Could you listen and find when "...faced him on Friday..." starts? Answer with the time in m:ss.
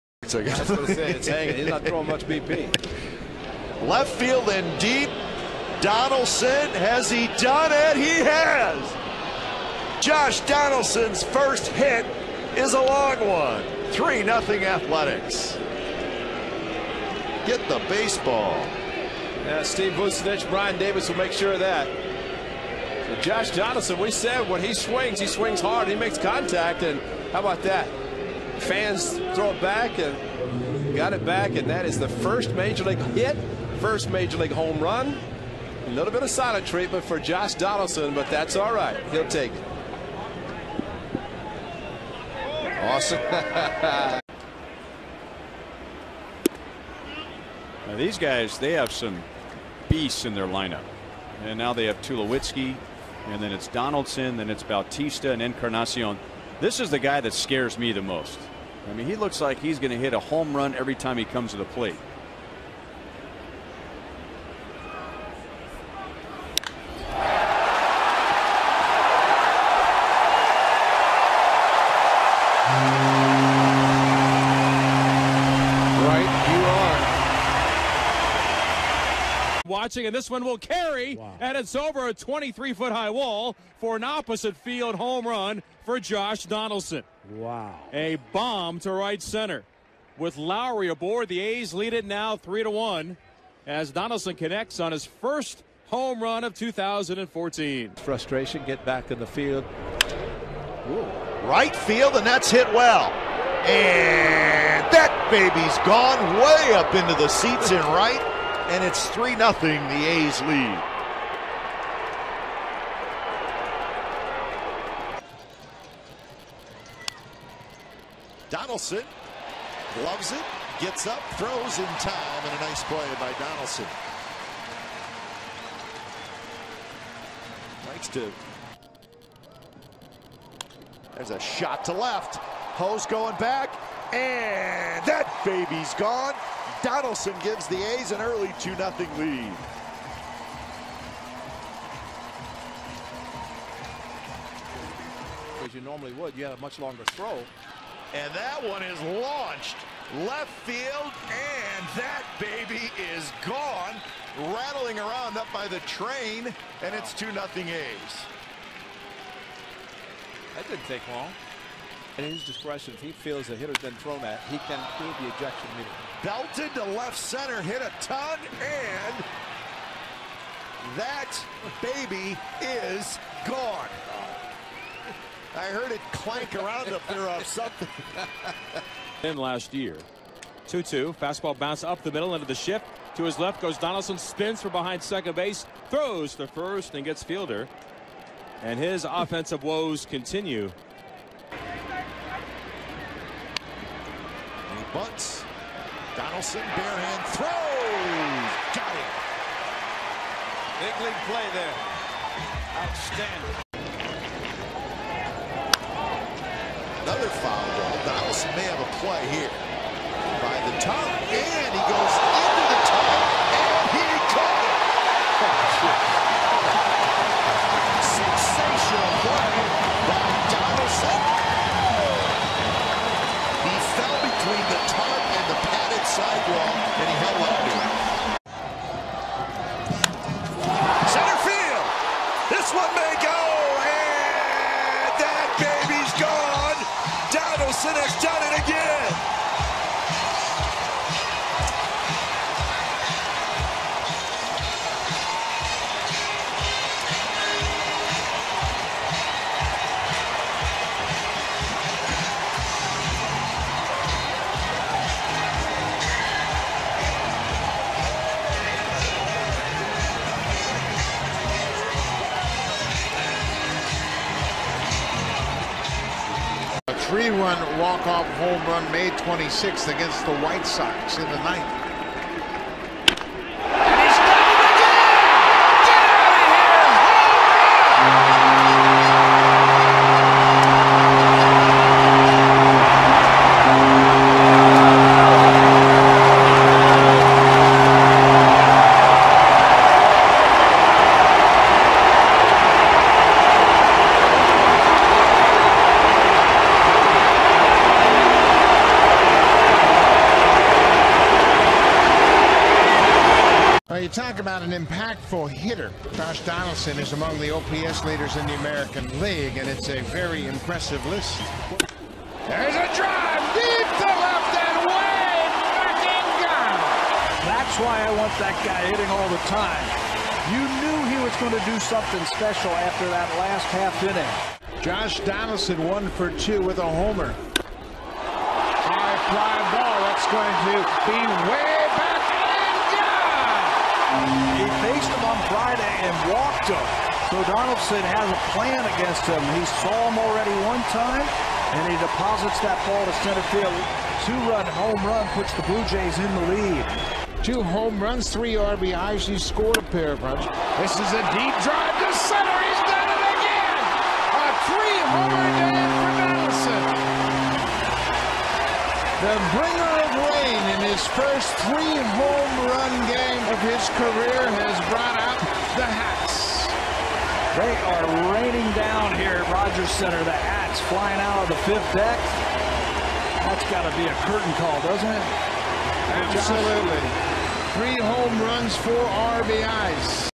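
5:35.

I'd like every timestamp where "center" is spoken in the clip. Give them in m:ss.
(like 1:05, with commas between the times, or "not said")
1:29, 2:47, 5:43, 5:52, 6:09.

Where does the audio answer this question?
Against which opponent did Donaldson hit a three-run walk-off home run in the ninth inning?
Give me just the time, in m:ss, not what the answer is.
4:30.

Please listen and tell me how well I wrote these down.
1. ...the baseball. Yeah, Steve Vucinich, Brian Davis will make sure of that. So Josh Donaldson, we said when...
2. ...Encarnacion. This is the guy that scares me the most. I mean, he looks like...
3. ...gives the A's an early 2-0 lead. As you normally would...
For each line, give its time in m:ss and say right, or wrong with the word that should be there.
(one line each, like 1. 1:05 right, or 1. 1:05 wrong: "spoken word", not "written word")
1. 0:17 right
2. 0:55 right
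3. 2:17 right.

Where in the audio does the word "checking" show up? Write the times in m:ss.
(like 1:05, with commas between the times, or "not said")
not said.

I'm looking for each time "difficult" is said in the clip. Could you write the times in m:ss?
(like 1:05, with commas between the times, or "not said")
not said.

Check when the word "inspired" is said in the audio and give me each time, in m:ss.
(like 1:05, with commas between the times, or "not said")
not said.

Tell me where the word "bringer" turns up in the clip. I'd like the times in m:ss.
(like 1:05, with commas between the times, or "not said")
5:59.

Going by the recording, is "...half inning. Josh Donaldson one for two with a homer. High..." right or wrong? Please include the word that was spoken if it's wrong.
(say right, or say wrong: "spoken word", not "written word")
right.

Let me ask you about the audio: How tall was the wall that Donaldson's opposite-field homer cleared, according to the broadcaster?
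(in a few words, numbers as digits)
23 feet.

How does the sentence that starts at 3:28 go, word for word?
Donaldson may have a play here.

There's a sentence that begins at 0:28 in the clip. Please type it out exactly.
Fans throw it back and got it back, and that is the first Major League hit, first Major League home run.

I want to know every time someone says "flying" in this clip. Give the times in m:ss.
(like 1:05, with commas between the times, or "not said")
6:10.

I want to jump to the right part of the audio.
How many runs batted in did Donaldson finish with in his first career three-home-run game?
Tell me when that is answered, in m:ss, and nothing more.
6:18.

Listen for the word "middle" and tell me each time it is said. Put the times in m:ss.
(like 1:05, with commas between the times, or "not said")
3:02.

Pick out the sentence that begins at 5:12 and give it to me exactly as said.
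There's a drive deep to left and way back in gone.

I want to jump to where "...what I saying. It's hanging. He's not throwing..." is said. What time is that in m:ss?
0:00.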